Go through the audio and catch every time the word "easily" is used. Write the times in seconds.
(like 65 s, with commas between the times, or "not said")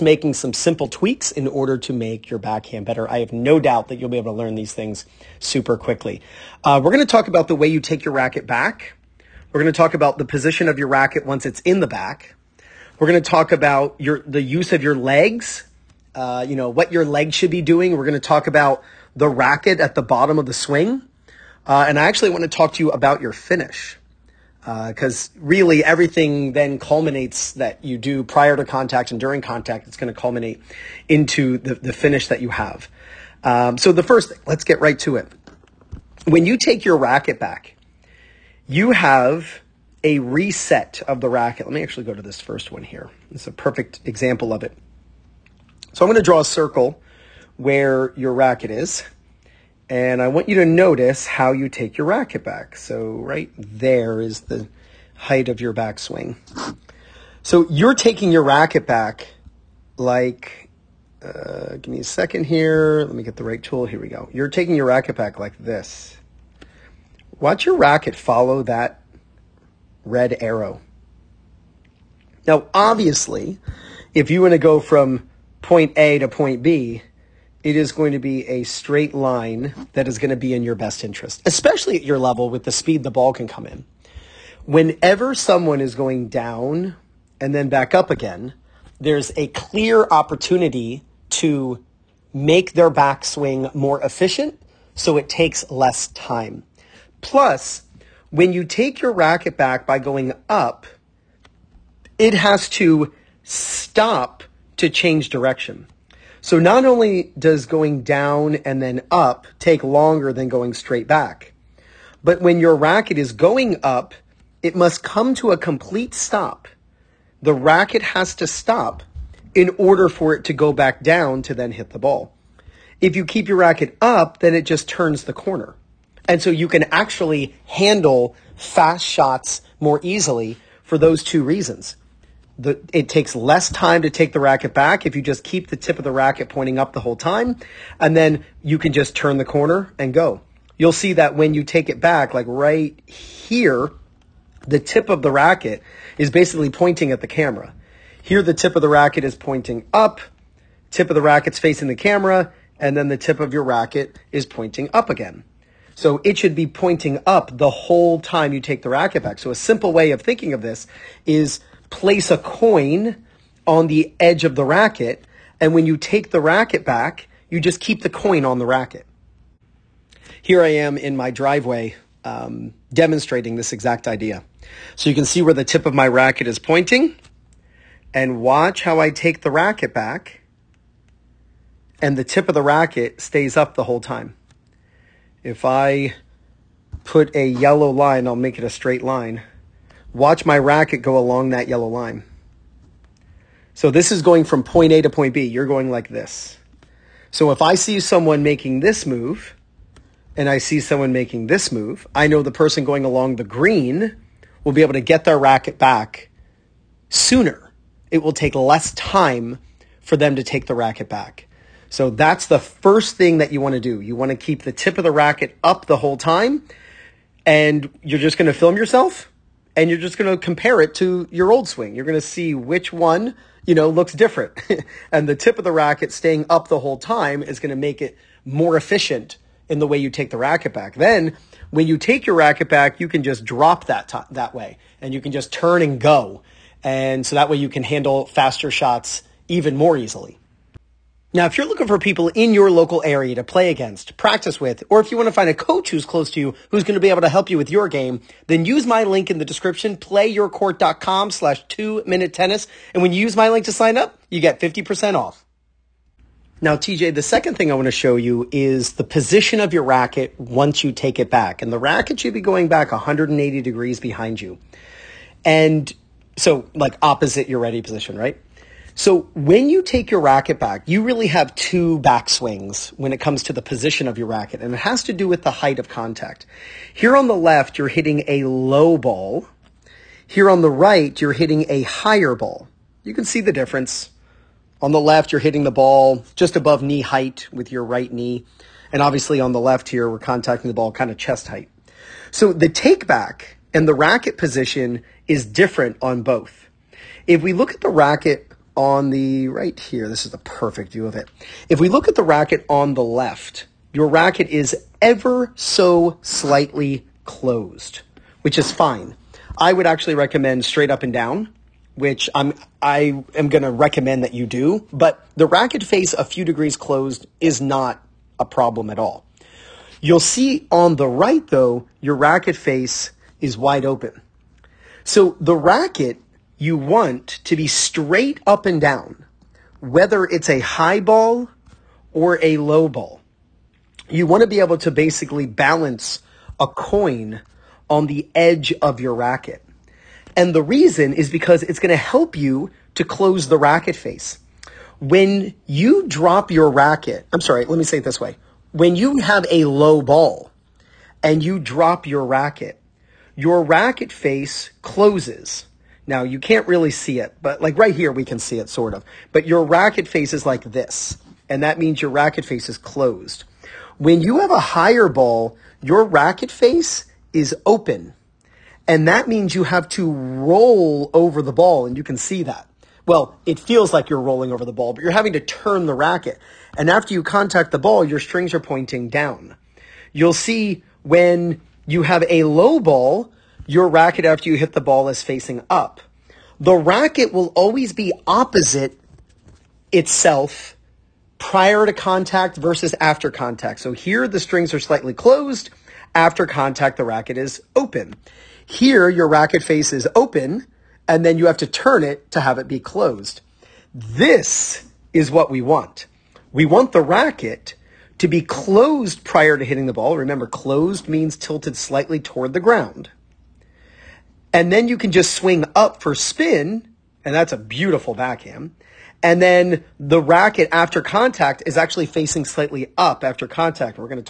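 130 s, 239 s.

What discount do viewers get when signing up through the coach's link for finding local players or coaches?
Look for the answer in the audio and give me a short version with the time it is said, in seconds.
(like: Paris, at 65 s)
50%, at 254 s.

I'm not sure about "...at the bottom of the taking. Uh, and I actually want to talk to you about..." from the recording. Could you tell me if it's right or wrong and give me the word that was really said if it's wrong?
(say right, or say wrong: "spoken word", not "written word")
wrong: "swing", not "taking".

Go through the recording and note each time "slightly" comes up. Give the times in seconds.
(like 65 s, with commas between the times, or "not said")
306 s, 394 s, 411 s, 422 s.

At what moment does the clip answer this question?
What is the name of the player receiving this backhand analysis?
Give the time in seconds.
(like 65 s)
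256 s.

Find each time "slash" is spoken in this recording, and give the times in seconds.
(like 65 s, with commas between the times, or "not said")
251 s.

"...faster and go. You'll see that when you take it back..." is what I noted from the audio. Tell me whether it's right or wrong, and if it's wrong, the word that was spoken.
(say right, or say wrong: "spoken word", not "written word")
wrong: "corner", not "faster".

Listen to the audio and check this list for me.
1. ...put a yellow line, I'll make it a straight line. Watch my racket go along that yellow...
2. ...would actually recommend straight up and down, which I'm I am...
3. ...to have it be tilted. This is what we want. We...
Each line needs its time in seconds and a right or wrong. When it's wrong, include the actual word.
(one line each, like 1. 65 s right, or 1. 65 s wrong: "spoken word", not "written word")
1. 187 s right
2. 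309 s right
3. 402 s wrong: "closed", not "tilted".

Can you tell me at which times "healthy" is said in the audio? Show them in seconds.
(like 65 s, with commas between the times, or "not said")
not said.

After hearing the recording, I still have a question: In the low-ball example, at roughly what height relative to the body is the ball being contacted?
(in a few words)
Just above knee height.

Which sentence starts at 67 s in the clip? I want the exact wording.
Watch your racket follow that red arrow.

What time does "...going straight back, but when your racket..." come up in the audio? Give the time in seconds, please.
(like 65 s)
110 s.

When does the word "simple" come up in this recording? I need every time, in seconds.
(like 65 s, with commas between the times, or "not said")
0 s, 159 s.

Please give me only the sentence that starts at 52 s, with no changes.
So right there is the height of your backswing.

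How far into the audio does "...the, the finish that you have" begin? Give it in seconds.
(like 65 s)
31 s.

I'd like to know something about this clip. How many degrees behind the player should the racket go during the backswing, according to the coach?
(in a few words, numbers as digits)
180.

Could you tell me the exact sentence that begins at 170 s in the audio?
Here I am in my driveway um, demonstrating this exact idea.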